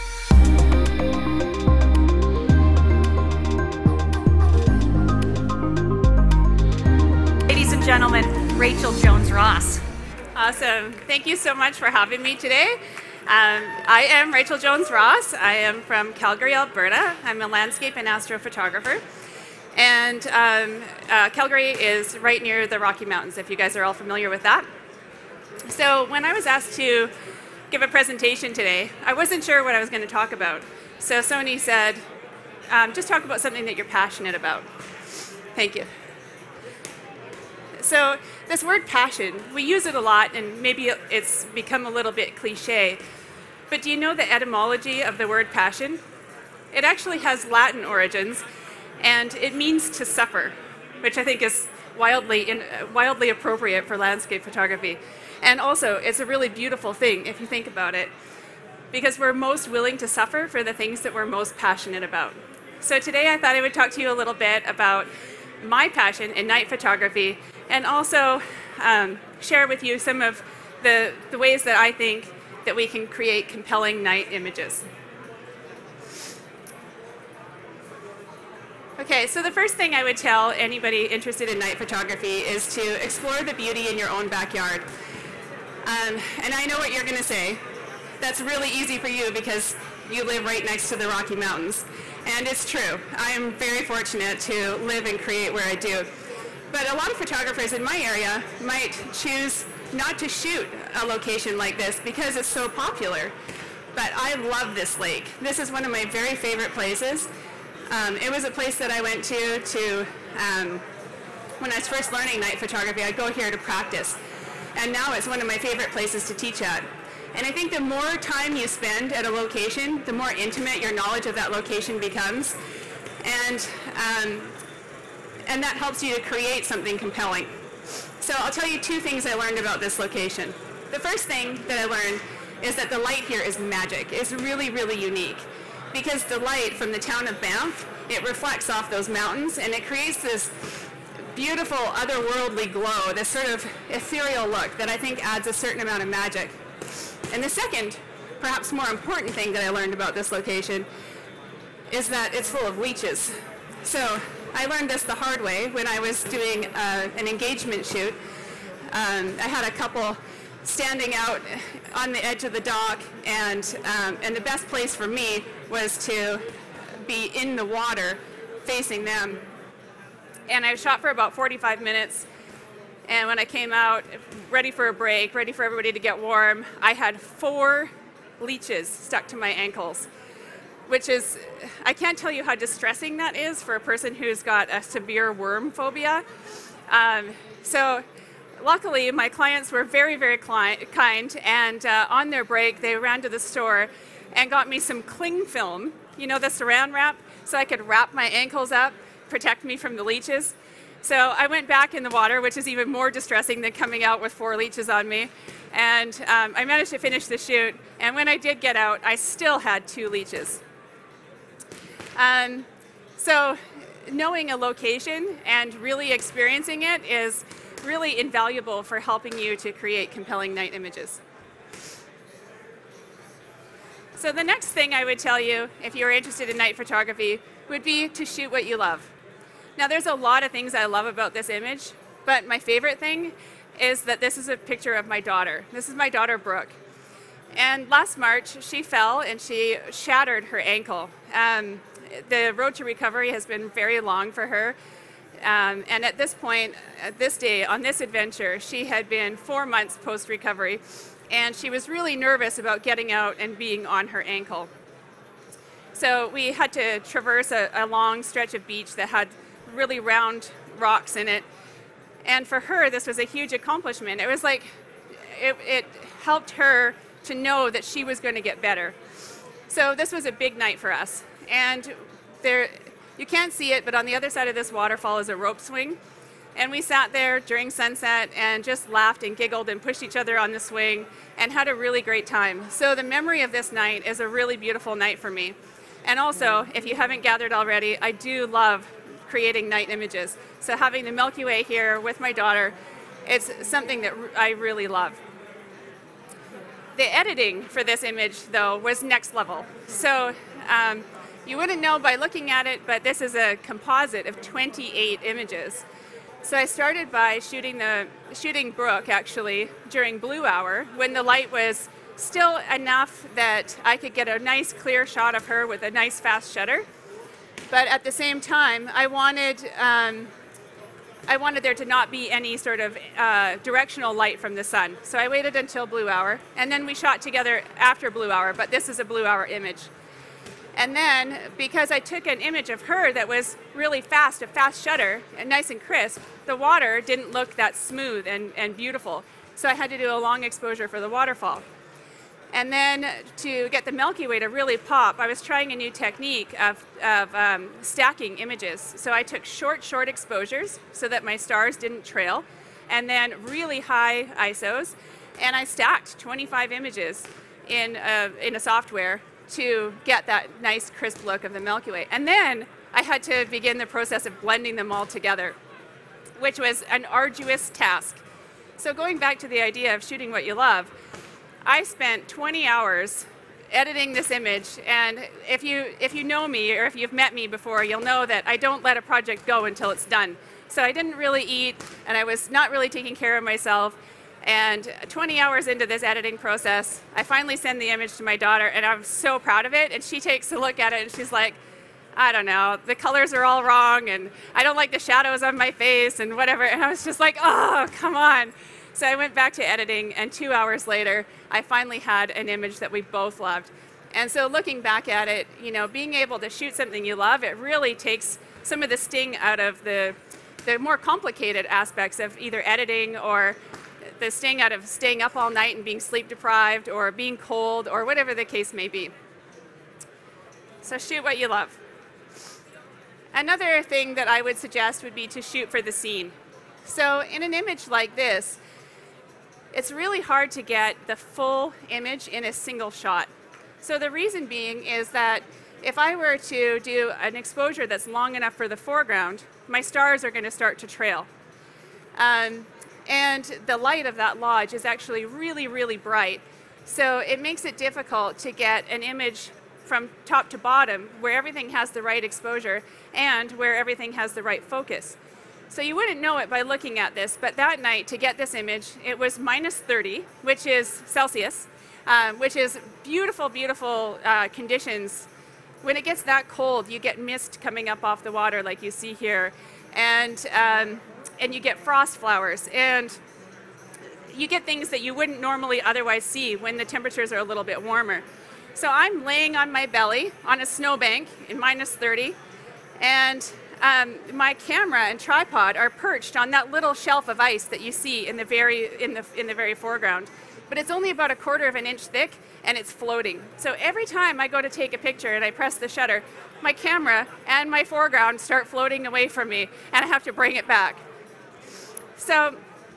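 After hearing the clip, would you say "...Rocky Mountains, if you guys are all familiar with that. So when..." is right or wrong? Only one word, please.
right.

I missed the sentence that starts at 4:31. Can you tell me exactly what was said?
And there, you can't see it, but on the other side of this waterfall is a rope swing.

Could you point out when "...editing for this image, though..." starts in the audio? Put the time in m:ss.
4:57.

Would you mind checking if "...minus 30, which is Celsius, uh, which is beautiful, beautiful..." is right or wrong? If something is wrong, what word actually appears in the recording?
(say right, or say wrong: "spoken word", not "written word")
right.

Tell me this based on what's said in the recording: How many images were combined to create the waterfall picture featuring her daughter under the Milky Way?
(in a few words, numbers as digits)
28.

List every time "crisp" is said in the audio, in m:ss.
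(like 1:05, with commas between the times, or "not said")
5:35, 6:00.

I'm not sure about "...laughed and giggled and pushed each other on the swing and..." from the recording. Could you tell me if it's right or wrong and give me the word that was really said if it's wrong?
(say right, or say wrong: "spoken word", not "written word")
right.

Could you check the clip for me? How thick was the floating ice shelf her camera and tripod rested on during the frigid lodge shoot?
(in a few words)
a quarter of an inch.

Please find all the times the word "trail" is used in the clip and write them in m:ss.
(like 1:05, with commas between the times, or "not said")
5:52, 7:20.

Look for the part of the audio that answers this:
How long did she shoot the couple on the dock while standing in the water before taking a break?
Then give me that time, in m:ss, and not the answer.
2:51.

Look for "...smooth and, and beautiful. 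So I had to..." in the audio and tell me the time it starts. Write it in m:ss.
5:37.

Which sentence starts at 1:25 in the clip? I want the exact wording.
Um, and I know what you're going to say.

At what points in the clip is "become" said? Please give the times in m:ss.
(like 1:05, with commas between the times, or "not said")
0:41, 2:01.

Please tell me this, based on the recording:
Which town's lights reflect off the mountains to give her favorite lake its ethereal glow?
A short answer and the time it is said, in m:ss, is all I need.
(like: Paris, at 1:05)
Banff, at 2:17.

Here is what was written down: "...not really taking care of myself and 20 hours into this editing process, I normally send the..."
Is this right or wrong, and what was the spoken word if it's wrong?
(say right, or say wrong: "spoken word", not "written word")
wrong: "finally", not "normally".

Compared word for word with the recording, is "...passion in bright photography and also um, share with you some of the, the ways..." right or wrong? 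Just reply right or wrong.
wrong.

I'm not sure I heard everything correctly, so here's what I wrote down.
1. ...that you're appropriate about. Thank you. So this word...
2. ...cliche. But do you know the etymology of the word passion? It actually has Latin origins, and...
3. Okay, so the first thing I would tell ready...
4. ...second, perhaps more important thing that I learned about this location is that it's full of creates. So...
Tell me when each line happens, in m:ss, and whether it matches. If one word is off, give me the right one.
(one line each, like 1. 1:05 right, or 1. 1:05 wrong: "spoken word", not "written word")
1. 0:33 wrong: "passionate", not "appropriate"
2. 0:42 right
3. 1:18 wrong: "anybody", not "ready"
4. 2:27 wrong: "leeches", not "creates".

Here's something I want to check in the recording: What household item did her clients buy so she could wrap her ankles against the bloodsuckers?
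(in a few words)
cling film.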